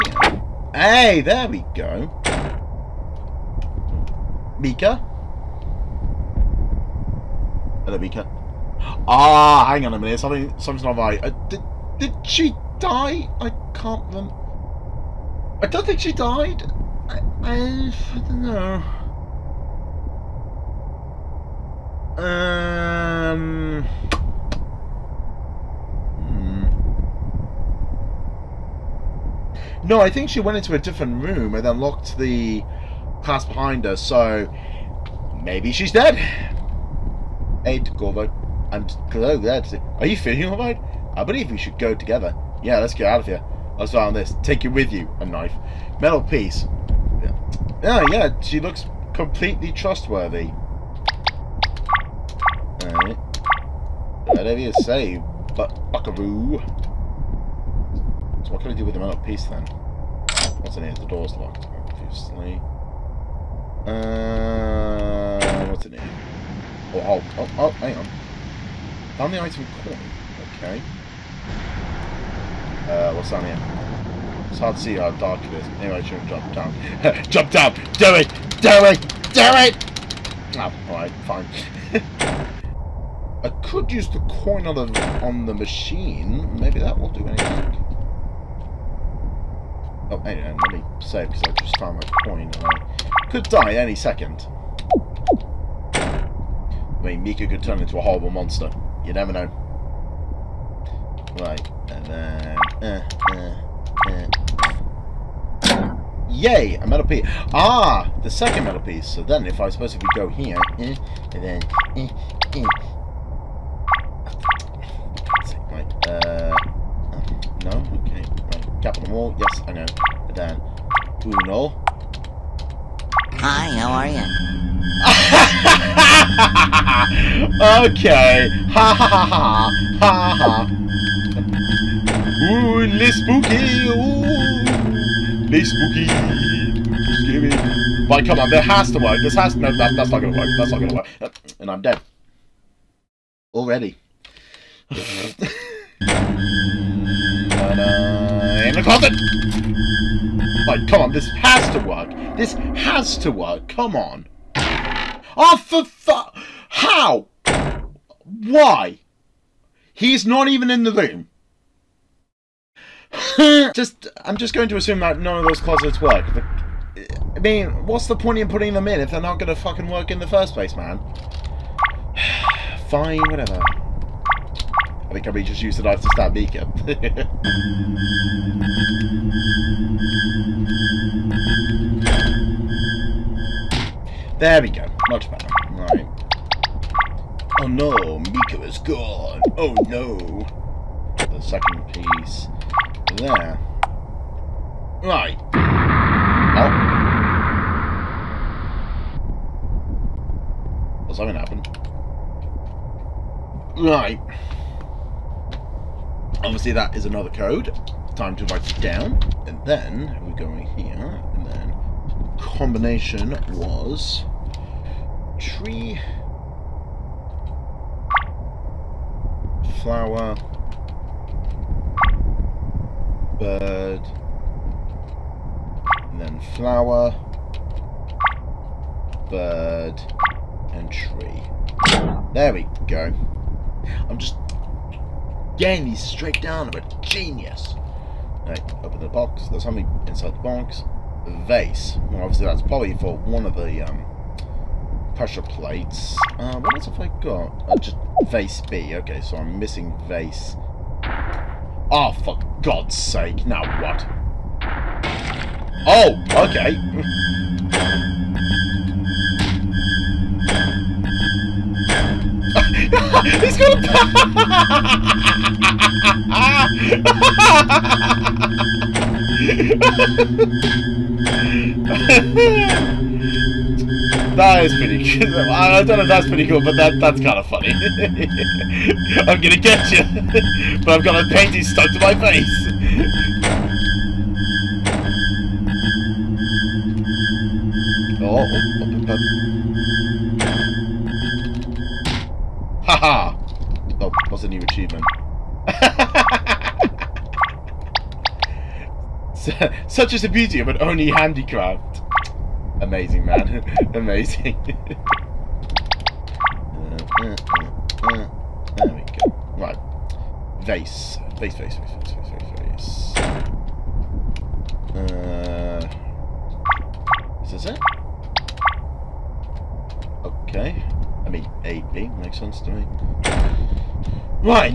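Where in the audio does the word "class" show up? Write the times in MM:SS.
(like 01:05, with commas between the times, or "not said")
00:33.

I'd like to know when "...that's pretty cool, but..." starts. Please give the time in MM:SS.
04:36.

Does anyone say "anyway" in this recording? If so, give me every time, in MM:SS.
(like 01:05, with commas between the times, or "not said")
01:15, 01:30.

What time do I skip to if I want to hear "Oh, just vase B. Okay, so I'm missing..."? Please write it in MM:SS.
04:07.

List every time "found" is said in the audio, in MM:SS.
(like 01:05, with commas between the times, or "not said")
01:09, 01:31.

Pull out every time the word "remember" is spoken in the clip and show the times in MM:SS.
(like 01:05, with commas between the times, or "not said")
00:14.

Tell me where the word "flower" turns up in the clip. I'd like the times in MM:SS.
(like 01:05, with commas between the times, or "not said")
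03:39, 03:46.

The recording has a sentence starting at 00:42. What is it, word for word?
Yeah, let's get out of here.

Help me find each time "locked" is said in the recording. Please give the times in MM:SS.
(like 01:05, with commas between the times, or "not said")
00:31, 01:01.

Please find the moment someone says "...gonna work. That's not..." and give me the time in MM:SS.
02:20.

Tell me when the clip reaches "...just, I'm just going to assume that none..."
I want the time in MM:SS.
02:43.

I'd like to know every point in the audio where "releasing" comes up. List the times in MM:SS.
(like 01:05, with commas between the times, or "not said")
not said.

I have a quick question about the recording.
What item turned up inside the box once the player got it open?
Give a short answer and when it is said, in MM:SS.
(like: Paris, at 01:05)
A vase, at 04:01.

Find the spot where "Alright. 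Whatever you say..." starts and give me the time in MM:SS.
00:52.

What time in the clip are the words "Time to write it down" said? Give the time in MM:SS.
03:28.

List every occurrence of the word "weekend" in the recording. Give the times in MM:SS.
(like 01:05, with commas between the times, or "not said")
00:08.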